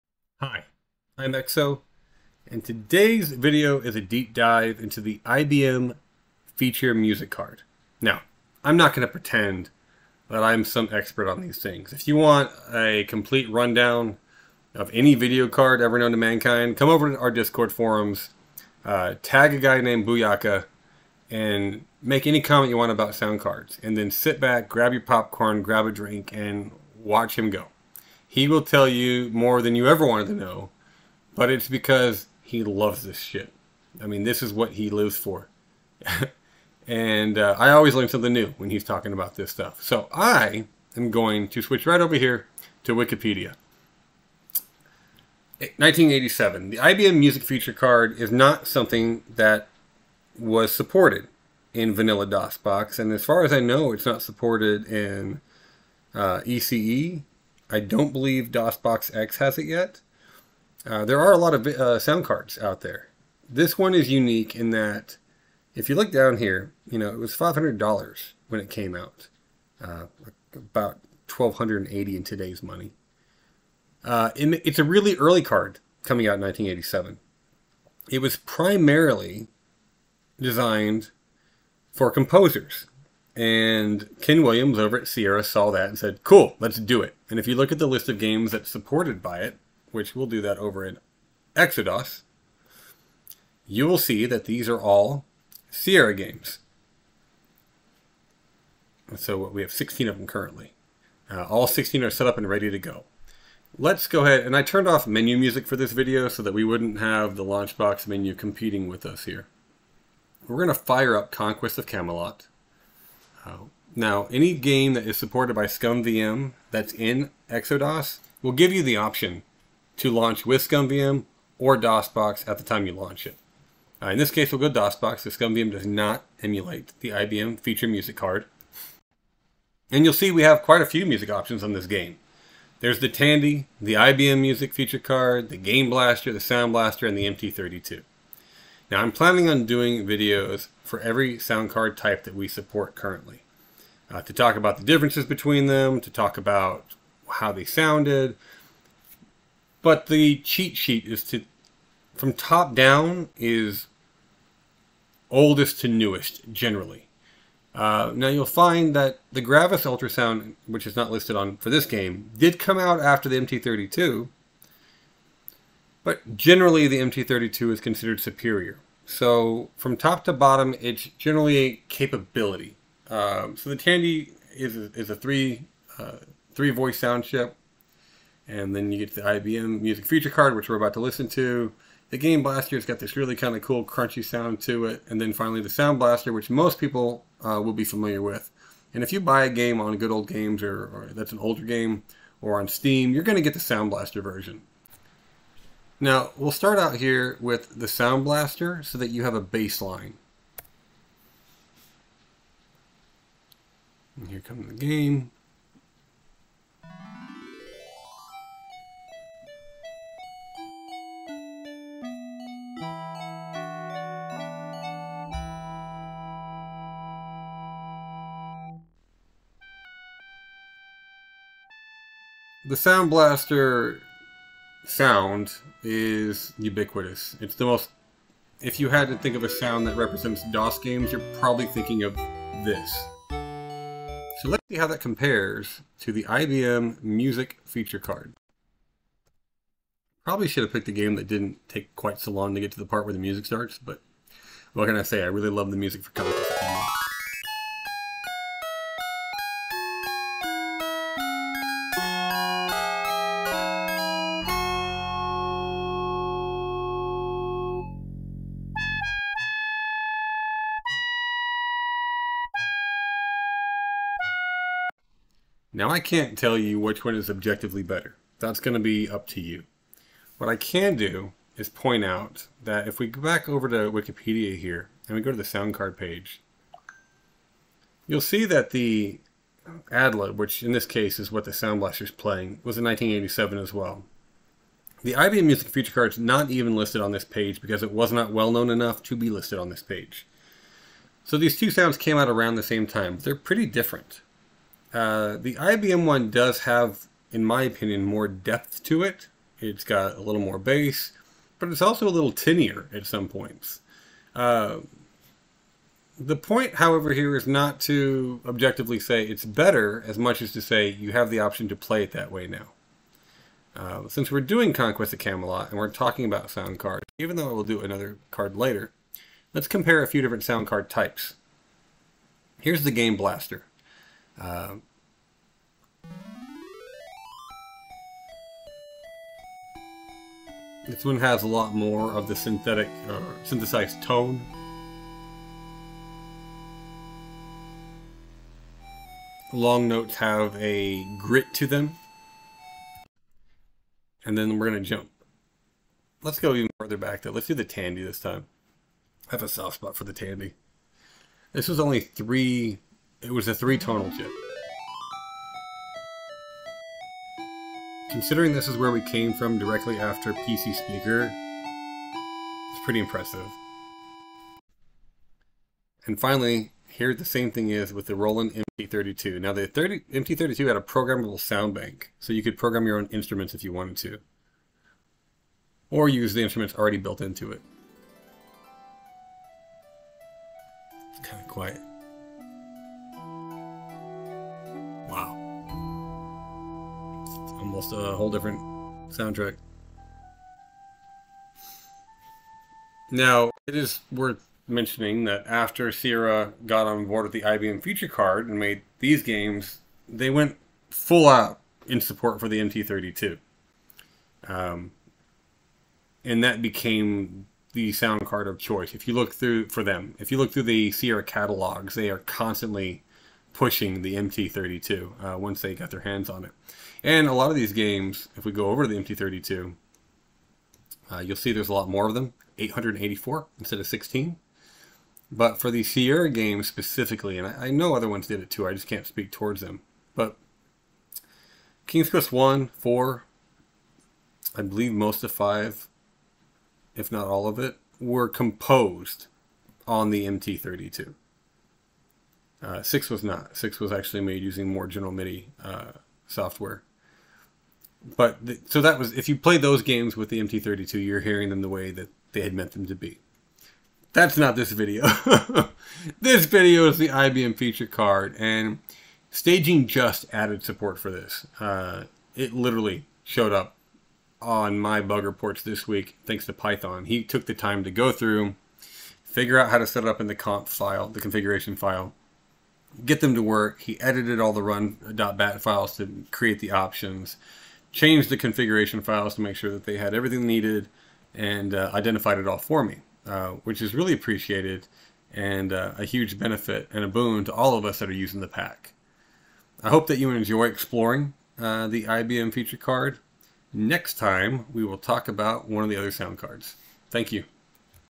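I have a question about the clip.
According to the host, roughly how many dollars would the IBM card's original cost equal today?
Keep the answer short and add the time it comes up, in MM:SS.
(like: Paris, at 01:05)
1280, at 01:11.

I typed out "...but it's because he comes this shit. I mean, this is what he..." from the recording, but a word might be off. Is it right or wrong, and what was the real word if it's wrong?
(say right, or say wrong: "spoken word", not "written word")
wrong: "loves", not "comes".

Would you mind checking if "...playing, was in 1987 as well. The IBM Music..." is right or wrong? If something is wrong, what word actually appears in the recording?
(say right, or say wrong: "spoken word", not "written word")
right.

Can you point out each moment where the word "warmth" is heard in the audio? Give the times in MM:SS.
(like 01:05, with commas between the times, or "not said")
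not said.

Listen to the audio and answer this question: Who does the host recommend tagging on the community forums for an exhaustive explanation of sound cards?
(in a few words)
Booyaka.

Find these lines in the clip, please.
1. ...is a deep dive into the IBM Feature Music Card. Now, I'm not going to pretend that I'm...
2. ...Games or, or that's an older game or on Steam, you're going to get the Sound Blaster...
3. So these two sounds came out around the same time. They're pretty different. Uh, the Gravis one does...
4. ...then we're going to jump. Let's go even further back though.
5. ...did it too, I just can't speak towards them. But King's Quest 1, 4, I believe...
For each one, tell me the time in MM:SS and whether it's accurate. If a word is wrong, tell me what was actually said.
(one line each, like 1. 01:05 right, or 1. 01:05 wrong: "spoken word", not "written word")
1. 00:03 right
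2. 03:10 right
3. 04:51 wrong: "IBM", not "Gravis"
4. 05:44 right
5. 07:08 right.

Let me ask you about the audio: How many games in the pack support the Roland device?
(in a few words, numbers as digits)
884.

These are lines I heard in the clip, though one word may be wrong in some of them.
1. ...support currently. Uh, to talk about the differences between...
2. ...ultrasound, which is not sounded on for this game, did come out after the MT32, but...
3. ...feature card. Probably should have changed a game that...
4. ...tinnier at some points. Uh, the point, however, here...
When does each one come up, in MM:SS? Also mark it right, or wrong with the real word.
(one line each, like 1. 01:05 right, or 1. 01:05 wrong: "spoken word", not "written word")
1. 02:22 right
2. 02:39 wrong: "listed", not "sounded"
3. 03:57 wrong: "picked", not "changed"
4. 05:02 right.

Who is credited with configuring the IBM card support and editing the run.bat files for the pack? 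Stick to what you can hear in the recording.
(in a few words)
Python.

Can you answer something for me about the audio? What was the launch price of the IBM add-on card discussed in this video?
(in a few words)
$500.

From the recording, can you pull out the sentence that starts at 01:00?
Uh, there are a lot of uh, sound cards out there.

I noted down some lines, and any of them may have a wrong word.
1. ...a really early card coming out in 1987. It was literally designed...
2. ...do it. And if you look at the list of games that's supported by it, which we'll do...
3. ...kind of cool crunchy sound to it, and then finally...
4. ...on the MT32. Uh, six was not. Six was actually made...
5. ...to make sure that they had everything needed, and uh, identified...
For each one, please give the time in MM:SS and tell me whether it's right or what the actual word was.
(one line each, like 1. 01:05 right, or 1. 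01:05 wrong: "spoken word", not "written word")
1. 01:14 wrong: "primarily", not "literally"
2. 01:26 right
3. 03:03 right
4. 07:19 right
5. 07:59 right.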